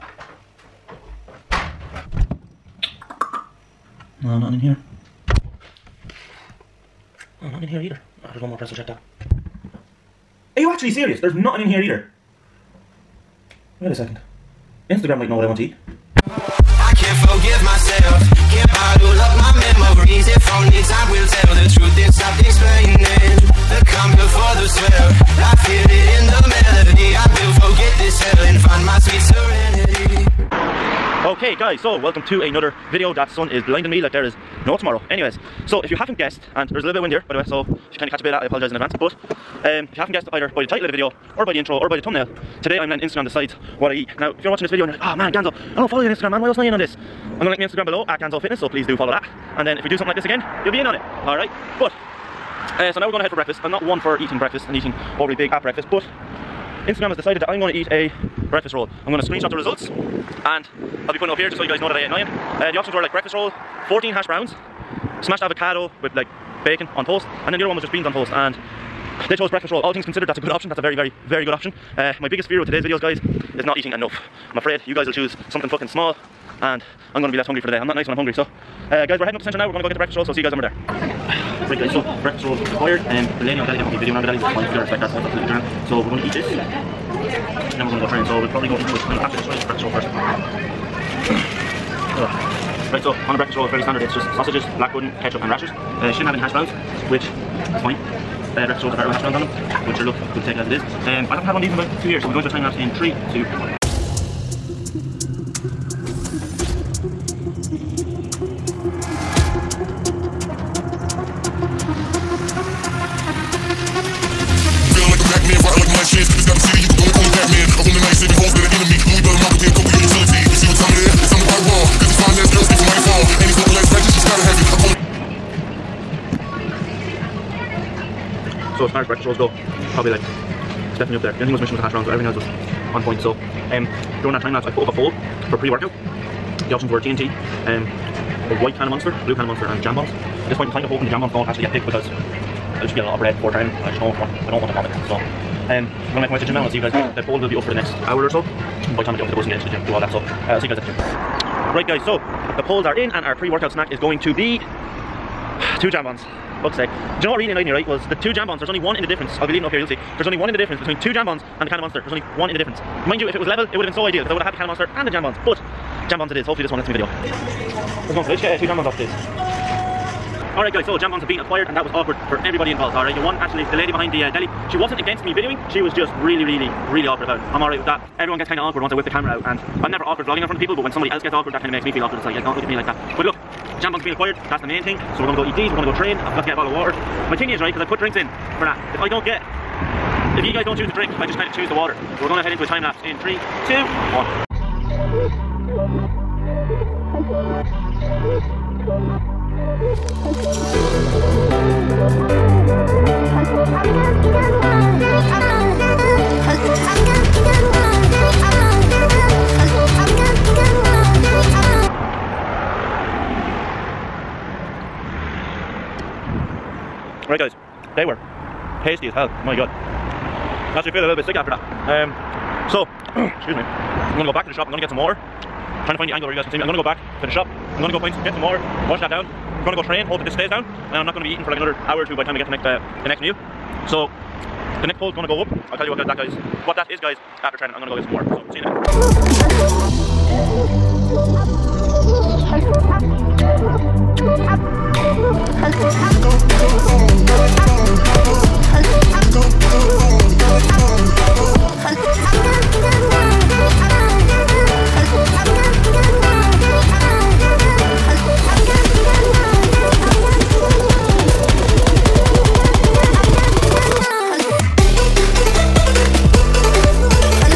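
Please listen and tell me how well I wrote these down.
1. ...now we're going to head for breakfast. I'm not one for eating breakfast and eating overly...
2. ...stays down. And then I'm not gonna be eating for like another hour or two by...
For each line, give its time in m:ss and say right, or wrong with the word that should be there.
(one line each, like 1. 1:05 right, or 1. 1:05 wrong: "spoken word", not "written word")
1. 0:52 right
2. 3:50 right.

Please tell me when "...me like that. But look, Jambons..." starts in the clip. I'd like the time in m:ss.
3:02.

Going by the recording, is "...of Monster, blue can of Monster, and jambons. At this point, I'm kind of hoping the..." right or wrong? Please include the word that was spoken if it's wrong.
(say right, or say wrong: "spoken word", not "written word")
right.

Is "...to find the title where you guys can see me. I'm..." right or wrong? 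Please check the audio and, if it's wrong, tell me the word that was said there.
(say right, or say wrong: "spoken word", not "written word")
wrong: "angle", not "title".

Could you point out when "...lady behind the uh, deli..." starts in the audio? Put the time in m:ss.
2:53.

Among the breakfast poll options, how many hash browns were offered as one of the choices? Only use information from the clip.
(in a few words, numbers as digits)
14.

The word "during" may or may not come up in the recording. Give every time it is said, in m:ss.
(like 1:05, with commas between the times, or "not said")
2:14.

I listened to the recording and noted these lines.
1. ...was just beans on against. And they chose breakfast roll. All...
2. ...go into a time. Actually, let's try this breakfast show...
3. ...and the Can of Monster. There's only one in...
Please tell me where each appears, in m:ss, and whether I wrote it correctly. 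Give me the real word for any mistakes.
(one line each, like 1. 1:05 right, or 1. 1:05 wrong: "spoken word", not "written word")
1. 1:07 wrong: "toast", not "against"
2. 1:28 right
3. 2:41 right.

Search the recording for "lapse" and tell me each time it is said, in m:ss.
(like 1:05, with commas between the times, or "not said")
1:42, 2:14, 3:12.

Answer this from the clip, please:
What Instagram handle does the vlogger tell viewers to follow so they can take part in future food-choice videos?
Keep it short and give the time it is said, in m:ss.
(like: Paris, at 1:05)
Ganzo Fitness, at 0:48.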